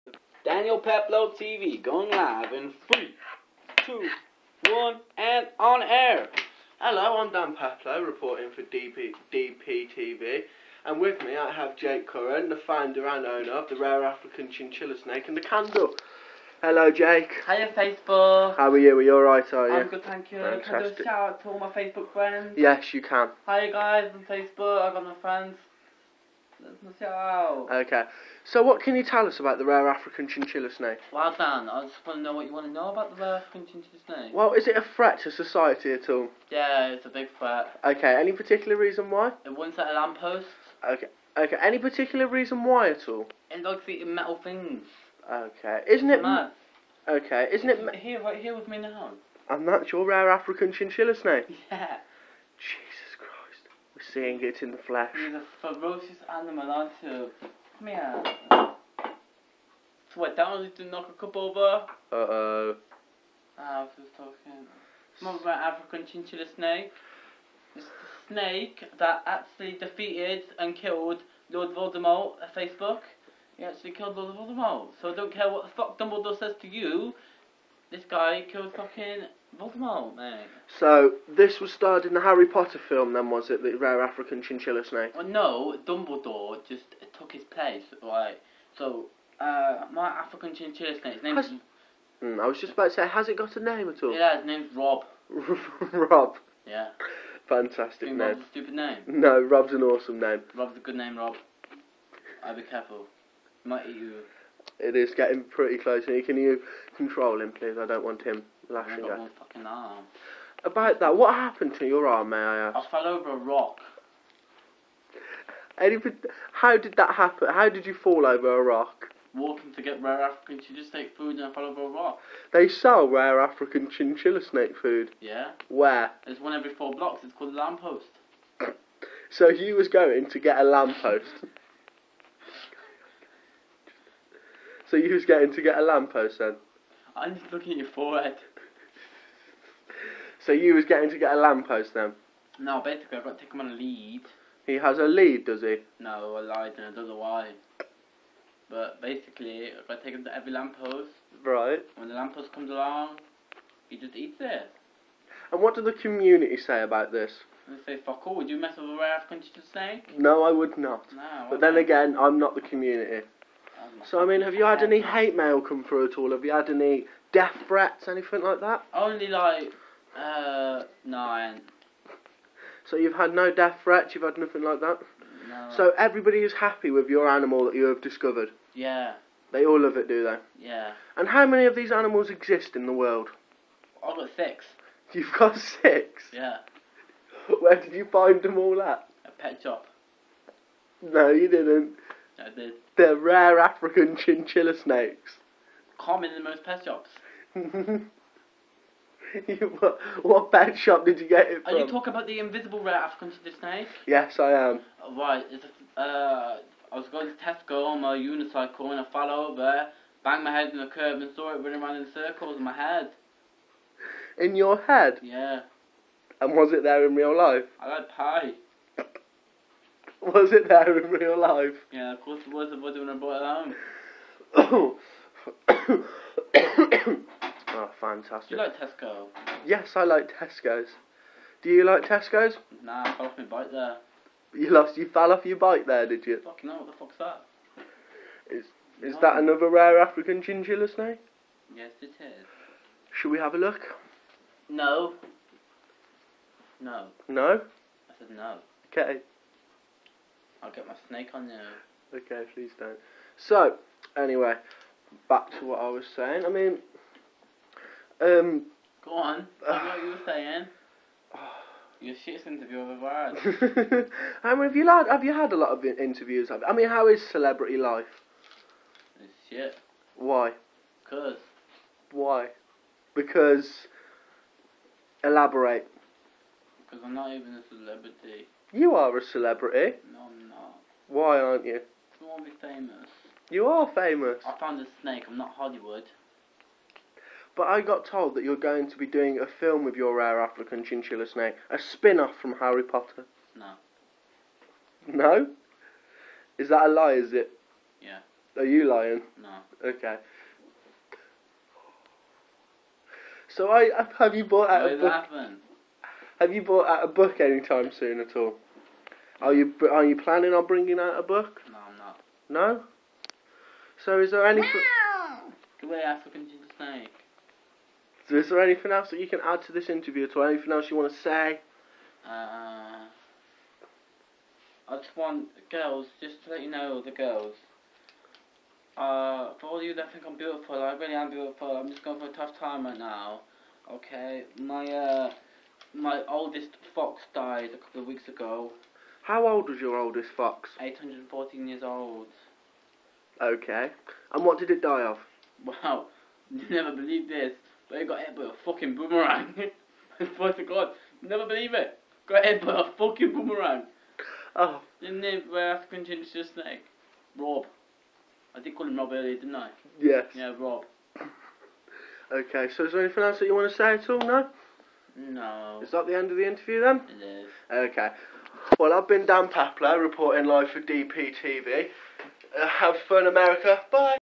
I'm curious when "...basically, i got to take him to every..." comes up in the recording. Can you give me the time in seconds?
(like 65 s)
149 s.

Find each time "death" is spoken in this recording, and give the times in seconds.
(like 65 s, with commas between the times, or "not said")
167 s, 173 s.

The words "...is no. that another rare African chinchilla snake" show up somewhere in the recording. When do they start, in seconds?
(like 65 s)
239 s.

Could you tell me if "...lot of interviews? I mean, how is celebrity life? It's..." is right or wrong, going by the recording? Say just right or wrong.
right.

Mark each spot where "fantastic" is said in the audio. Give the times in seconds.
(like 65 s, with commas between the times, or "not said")
20 s, 97 s, 227 s.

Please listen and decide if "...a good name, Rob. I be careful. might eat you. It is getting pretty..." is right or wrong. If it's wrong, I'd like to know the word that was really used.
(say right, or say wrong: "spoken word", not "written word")
right.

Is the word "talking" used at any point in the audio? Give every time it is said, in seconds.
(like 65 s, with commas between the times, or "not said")
64 s, 201 s.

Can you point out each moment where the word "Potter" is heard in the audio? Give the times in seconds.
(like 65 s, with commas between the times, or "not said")
82 s, 292 s.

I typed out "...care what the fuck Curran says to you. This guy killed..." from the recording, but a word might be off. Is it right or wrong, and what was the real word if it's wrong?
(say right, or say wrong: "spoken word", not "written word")
wrong: "Dumbledore", not "Curran".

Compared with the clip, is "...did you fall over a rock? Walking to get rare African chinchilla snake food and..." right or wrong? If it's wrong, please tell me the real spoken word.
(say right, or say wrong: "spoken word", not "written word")
right.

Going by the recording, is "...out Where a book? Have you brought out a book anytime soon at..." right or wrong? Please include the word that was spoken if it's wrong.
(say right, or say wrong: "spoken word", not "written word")
wrong: "bought", not "brought".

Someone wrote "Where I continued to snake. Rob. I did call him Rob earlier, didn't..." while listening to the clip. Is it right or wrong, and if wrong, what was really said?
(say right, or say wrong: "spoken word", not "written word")
right.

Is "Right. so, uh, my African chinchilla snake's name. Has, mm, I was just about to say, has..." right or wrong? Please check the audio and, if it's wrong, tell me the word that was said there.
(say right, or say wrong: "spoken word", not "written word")
right.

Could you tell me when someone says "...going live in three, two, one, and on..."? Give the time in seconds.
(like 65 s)
1 s.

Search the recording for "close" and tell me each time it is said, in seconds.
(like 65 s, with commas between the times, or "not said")
105 s.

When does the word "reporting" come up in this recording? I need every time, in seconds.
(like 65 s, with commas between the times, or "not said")
8 s, 370 s.